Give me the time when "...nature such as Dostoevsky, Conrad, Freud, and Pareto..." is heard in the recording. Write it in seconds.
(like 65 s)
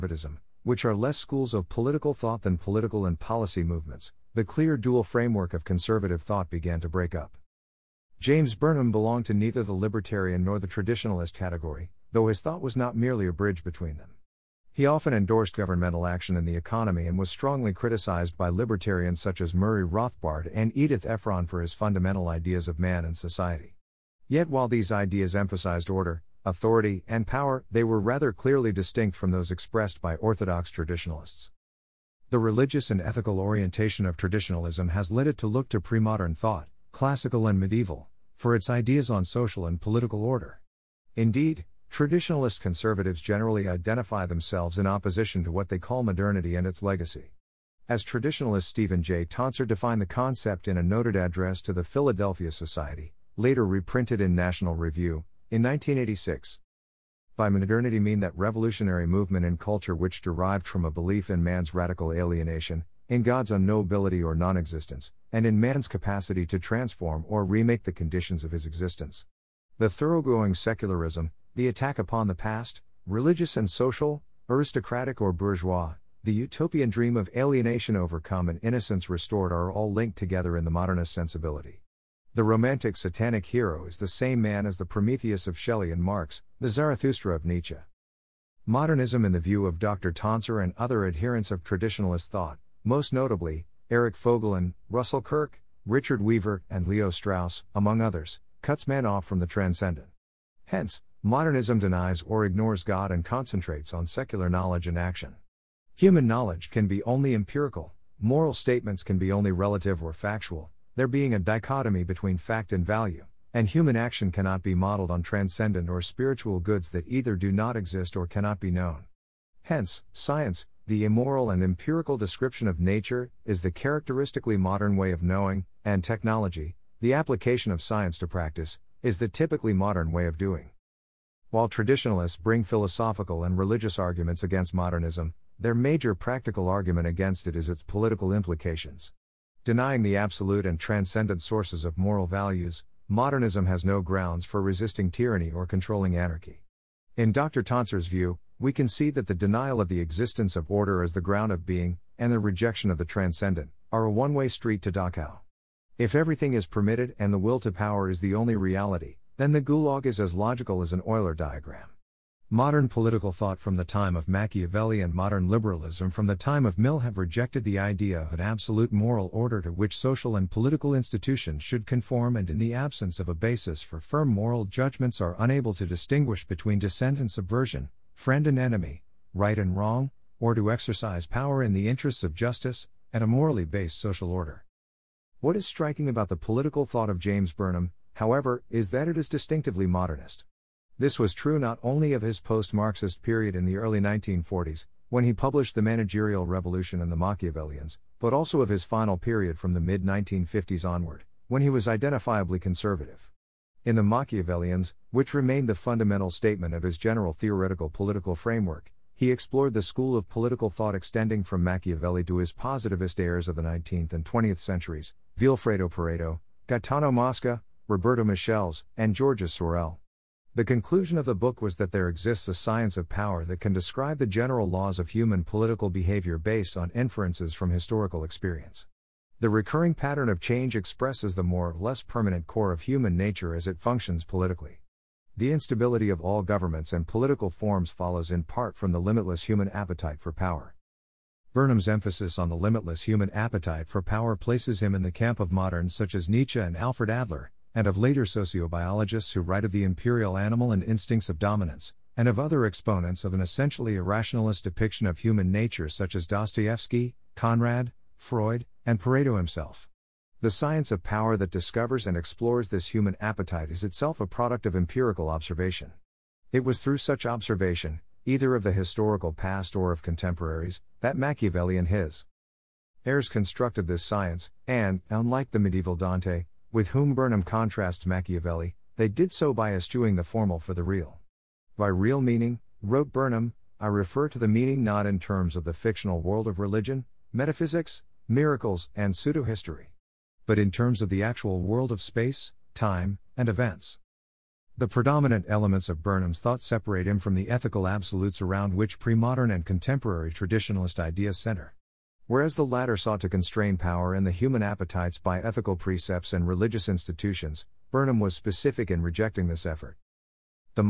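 255 s.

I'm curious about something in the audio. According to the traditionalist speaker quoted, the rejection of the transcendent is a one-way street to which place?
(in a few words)
Dachau.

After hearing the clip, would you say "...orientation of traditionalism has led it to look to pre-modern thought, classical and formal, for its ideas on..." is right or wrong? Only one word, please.
wrong.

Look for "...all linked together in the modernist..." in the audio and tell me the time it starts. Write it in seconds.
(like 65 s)
79 s.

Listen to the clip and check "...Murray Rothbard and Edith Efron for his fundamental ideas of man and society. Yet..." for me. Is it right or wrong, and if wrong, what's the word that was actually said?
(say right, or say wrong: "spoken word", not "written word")
right.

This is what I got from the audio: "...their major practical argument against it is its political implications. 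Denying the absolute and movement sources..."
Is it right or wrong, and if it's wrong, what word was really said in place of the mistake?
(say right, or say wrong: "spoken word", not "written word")
wrong: "transcendent", not "movement".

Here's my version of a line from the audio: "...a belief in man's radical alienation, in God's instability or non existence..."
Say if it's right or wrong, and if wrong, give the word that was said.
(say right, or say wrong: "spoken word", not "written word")
wrong: "unknowability", not "instability".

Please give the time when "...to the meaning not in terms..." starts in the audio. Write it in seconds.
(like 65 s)
284 s.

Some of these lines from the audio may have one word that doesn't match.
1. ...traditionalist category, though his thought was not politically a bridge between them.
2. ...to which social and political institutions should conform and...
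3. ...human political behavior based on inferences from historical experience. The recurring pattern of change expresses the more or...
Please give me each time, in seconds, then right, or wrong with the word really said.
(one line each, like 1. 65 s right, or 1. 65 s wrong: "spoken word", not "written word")
1. 10 s wrong: "merely", not "politically"
2. 169 s right
3. 225 s right.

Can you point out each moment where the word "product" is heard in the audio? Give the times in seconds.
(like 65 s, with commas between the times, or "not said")
264 s.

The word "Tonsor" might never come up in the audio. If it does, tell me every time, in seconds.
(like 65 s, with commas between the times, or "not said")
49 s, 90 s, 147 s.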